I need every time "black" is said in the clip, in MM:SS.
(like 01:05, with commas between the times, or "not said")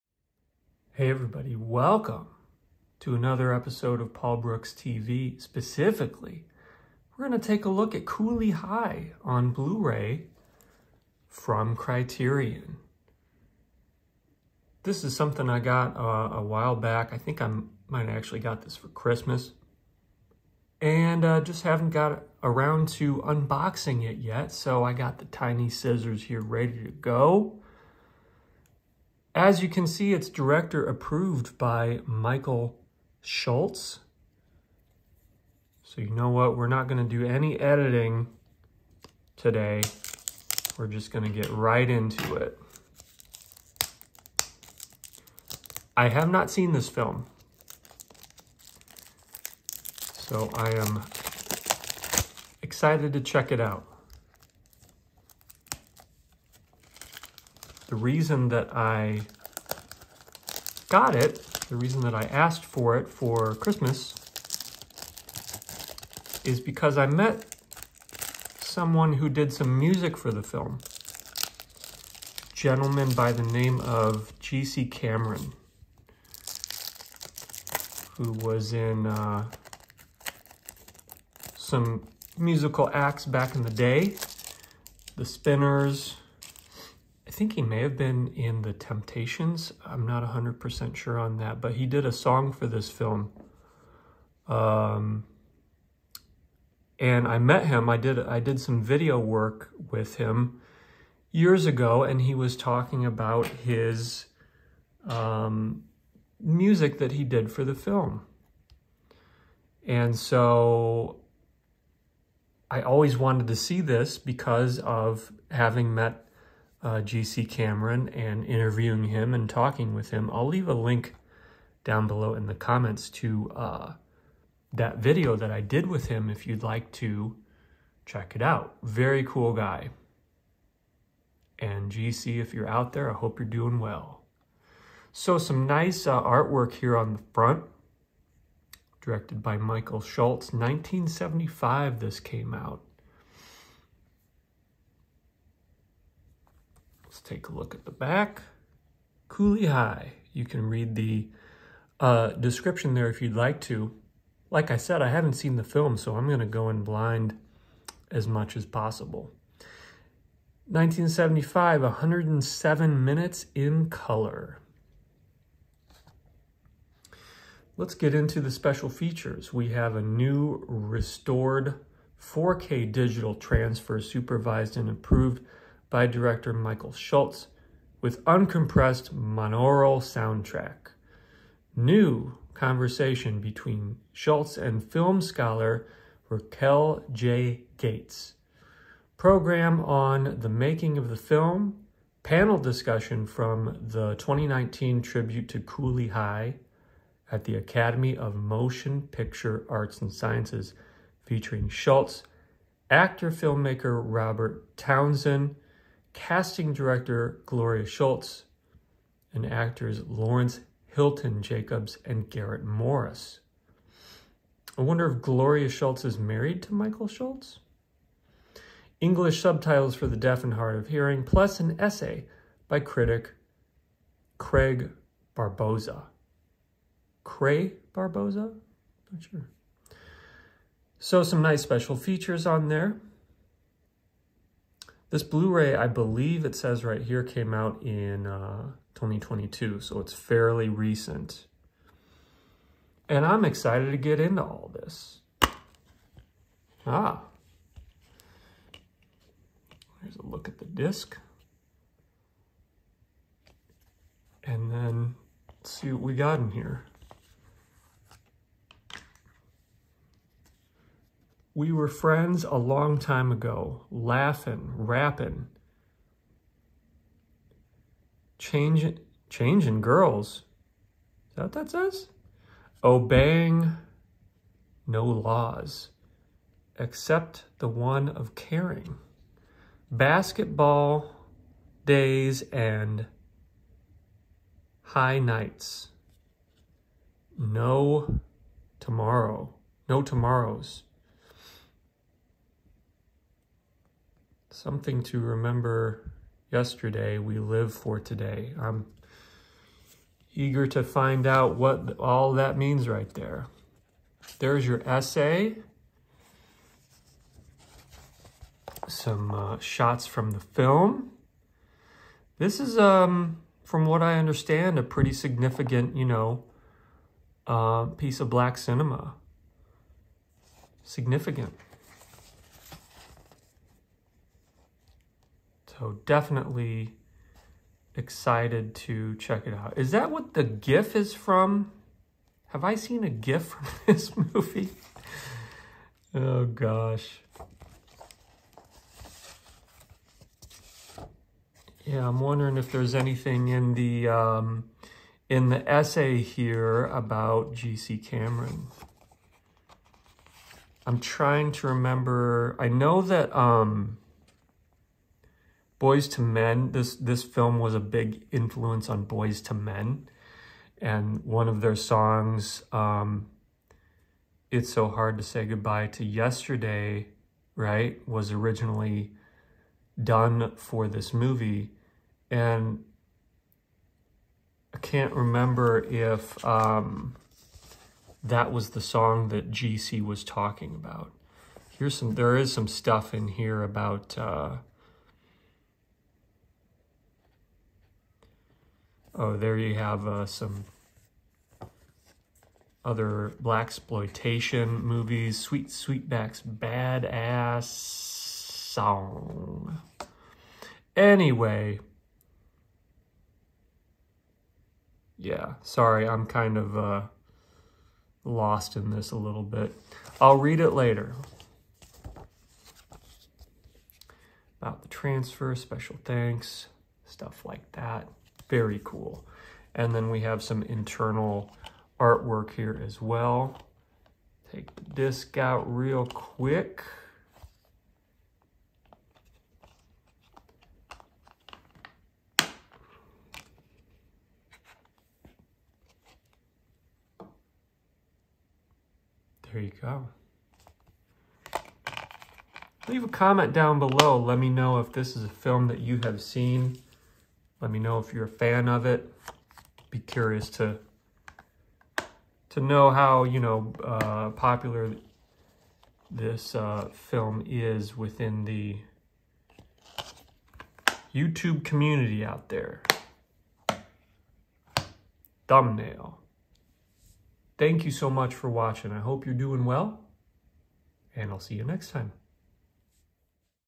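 05:18, 06:33.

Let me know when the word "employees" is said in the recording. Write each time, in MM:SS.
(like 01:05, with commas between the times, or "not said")
not said.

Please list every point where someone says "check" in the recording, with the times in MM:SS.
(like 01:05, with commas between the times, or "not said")
00:53, 02:08, 05:29.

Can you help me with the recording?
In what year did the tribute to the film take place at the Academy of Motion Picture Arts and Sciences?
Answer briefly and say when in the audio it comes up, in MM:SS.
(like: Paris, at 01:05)
2019, at 03:14.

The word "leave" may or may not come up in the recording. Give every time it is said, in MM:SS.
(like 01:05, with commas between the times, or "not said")
02:00, 07:22.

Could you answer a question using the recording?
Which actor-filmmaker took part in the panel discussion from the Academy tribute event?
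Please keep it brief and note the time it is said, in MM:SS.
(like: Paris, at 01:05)
Robert Townsend, at 03:24.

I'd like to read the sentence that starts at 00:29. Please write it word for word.
As you can see, it's director approved by Michael Schultz.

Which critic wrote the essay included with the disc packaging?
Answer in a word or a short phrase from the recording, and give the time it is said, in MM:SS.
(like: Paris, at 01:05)
Craig Barboza, at 03:44.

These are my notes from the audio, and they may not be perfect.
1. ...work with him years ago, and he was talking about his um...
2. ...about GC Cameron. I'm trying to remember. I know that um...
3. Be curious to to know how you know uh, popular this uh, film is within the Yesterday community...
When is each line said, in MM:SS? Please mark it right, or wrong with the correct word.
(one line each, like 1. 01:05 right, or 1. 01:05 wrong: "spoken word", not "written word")
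1. 01:39 right
2. 05:46 right
3. 07:29 wrong: "YouTube", not "Yesterday".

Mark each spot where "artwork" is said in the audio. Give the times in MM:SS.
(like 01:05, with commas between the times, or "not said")
02:16, 07:02.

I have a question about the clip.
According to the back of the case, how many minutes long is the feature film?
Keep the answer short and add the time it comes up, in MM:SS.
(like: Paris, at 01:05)
107, at 02:41.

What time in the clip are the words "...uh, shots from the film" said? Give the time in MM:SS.
05:09.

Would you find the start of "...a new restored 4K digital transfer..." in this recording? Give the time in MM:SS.
02:49.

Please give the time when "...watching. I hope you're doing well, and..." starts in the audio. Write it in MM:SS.
07:48.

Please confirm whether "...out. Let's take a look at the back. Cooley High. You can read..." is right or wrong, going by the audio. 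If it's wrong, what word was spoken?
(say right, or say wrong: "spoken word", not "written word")
right.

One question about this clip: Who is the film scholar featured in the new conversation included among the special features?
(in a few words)
Raquel J. Gates.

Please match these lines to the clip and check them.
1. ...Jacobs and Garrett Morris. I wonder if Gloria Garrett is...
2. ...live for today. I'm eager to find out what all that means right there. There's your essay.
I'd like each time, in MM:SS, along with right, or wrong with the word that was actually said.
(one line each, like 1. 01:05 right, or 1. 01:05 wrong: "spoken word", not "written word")
1. 03:31 wrong: "Schultz", not "Garrett"
2. 04:57 right.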